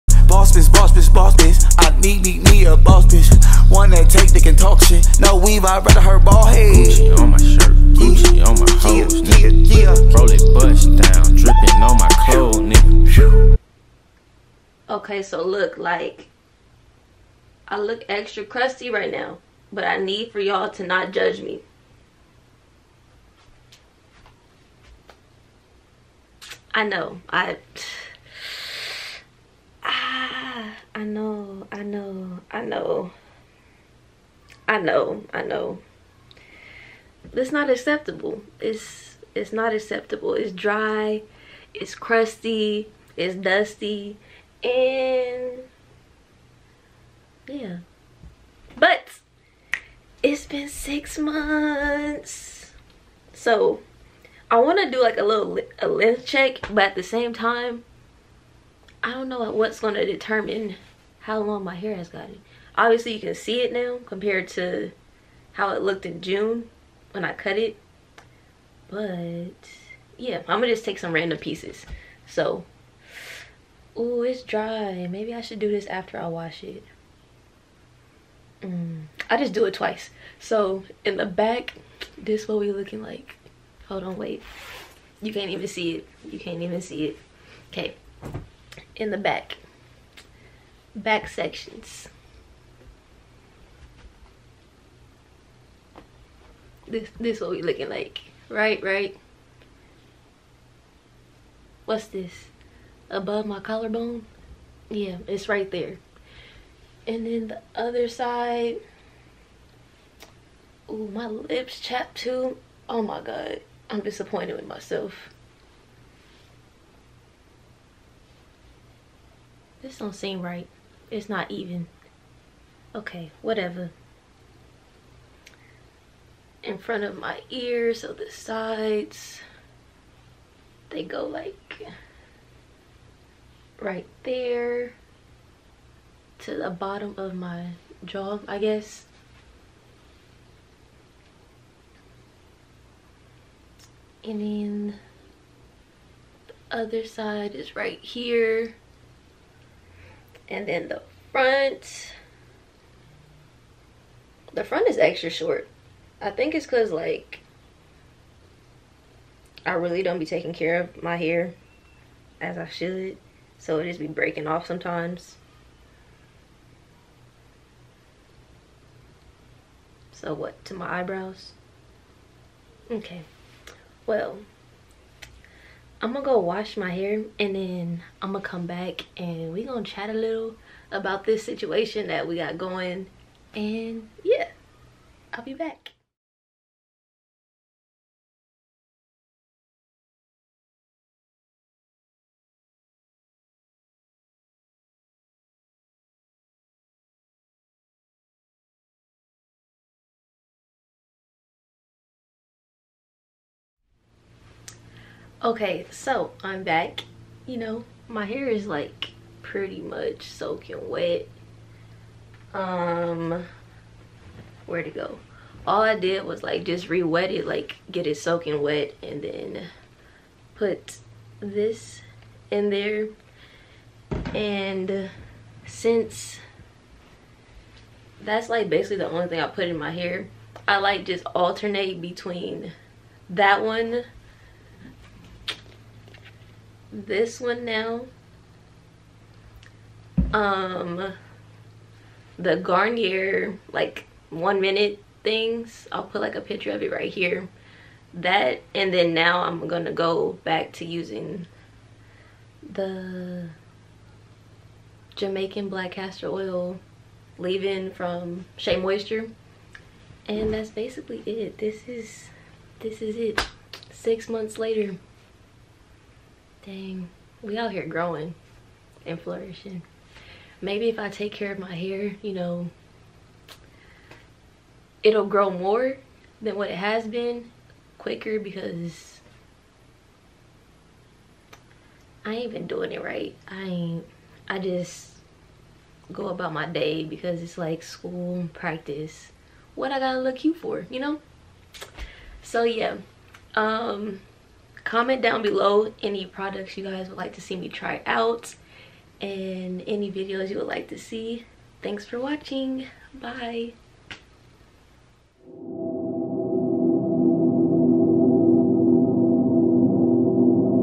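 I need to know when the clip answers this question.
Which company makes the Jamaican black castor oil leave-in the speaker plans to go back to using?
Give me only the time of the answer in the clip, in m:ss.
4:18.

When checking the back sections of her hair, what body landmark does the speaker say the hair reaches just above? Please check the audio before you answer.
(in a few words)
Collarbone.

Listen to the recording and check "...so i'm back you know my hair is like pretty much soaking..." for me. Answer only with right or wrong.
right.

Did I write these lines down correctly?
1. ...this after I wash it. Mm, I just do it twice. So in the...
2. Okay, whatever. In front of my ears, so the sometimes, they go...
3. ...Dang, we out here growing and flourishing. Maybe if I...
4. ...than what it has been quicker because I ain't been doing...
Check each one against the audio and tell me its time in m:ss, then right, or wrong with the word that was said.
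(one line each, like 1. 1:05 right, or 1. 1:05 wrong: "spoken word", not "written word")
1. 1:15 right
2. 2:02 wrong: "sides", not "sometimes"
3. 4:26 right
4. 4:36 right.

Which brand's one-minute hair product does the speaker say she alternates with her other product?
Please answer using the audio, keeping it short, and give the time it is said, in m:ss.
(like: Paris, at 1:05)
Garnier, at 4:02.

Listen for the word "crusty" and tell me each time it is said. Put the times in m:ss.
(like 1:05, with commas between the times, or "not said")
0:18, 0:41.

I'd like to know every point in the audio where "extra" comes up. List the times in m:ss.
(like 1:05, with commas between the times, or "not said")
0:18, 2:34.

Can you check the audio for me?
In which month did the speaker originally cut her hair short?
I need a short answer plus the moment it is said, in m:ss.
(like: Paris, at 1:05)
June, at 1:06.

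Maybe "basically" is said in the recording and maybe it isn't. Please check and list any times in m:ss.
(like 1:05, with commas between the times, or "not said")
3:48, 4:20.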